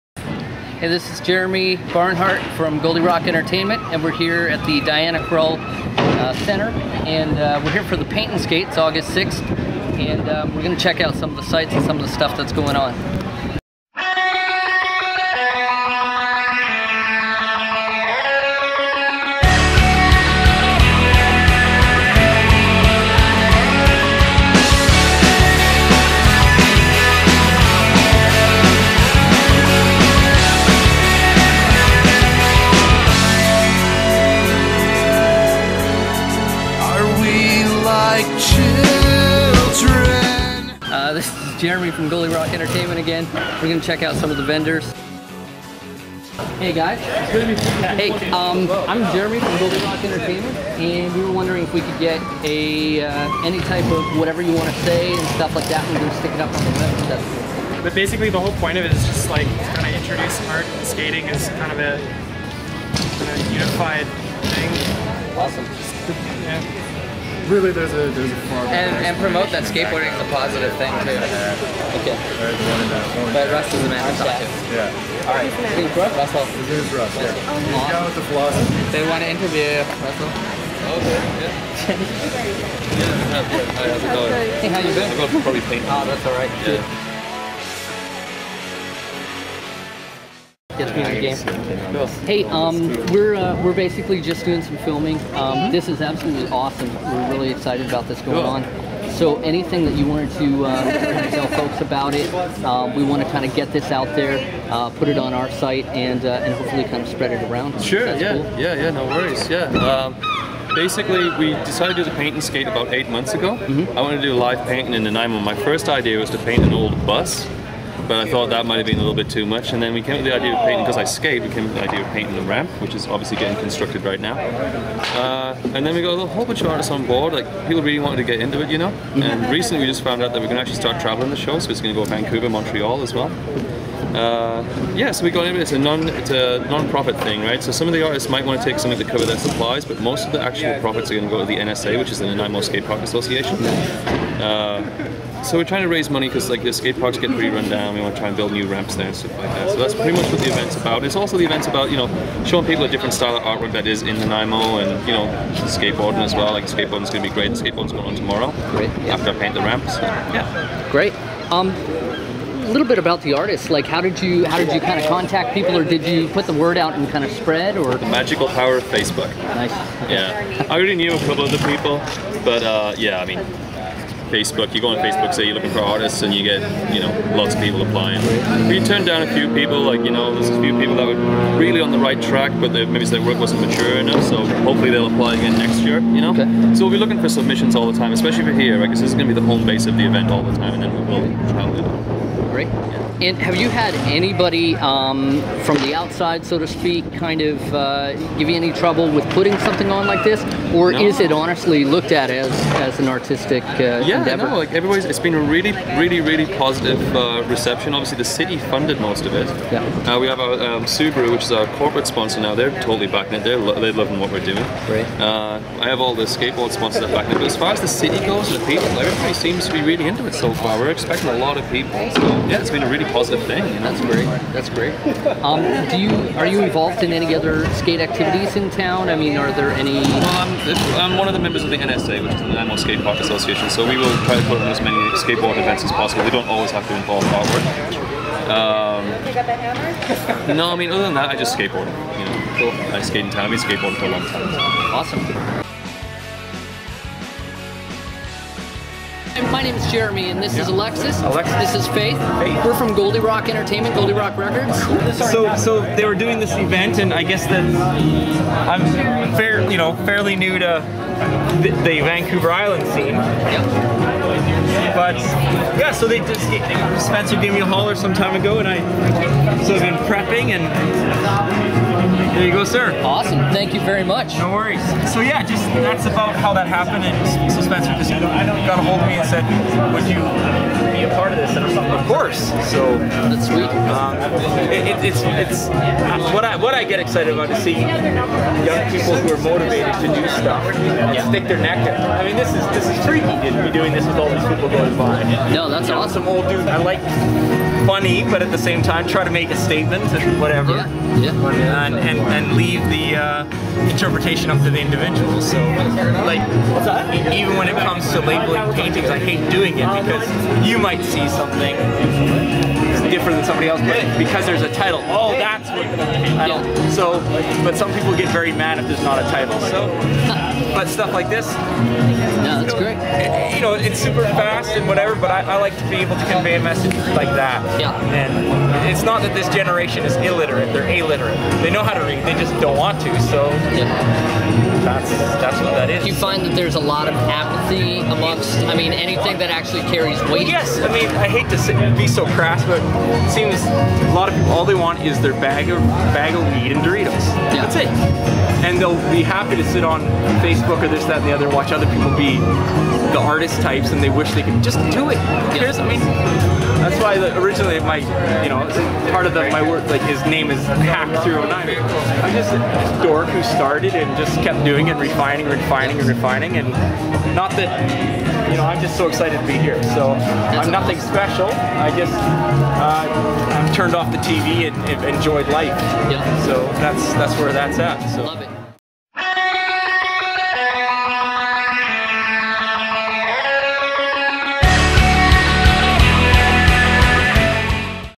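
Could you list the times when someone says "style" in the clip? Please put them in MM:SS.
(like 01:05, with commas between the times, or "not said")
02:33.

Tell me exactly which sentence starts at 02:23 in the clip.
Uh, so we're trying to raise money because like the skate parks get pretty run down.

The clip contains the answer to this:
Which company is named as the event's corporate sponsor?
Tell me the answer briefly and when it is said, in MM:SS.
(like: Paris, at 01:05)
Subaru, at 03:30.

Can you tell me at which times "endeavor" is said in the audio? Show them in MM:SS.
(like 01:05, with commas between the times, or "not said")
03:24.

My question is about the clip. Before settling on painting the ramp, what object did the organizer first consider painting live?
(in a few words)
An old bus.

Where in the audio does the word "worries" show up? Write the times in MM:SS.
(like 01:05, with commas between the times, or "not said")
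01:49, 04:34.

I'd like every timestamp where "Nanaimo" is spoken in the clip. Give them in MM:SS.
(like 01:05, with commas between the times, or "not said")
01:55, 02:22, 02:34, 03:52.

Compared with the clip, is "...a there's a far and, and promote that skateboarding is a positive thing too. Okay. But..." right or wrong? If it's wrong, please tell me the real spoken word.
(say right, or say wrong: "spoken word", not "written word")
right.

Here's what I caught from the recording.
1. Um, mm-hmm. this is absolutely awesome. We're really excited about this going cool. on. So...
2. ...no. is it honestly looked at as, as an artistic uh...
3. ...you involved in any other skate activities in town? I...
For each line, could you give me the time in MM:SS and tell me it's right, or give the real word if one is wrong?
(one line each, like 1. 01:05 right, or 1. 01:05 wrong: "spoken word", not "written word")
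1. 01:35 right
2. 03:20 right
3. 03:46 right.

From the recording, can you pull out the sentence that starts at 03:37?
But as far as the city goes and the people, everybody seems to be really into it so far.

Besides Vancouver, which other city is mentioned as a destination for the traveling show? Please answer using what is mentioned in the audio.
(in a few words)
Montreal.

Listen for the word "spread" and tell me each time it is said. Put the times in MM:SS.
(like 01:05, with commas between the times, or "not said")
01:47, 02:47.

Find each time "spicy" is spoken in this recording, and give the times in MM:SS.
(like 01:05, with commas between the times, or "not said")
not said.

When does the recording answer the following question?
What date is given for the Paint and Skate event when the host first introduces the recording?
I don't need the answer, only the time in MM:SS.
00:08.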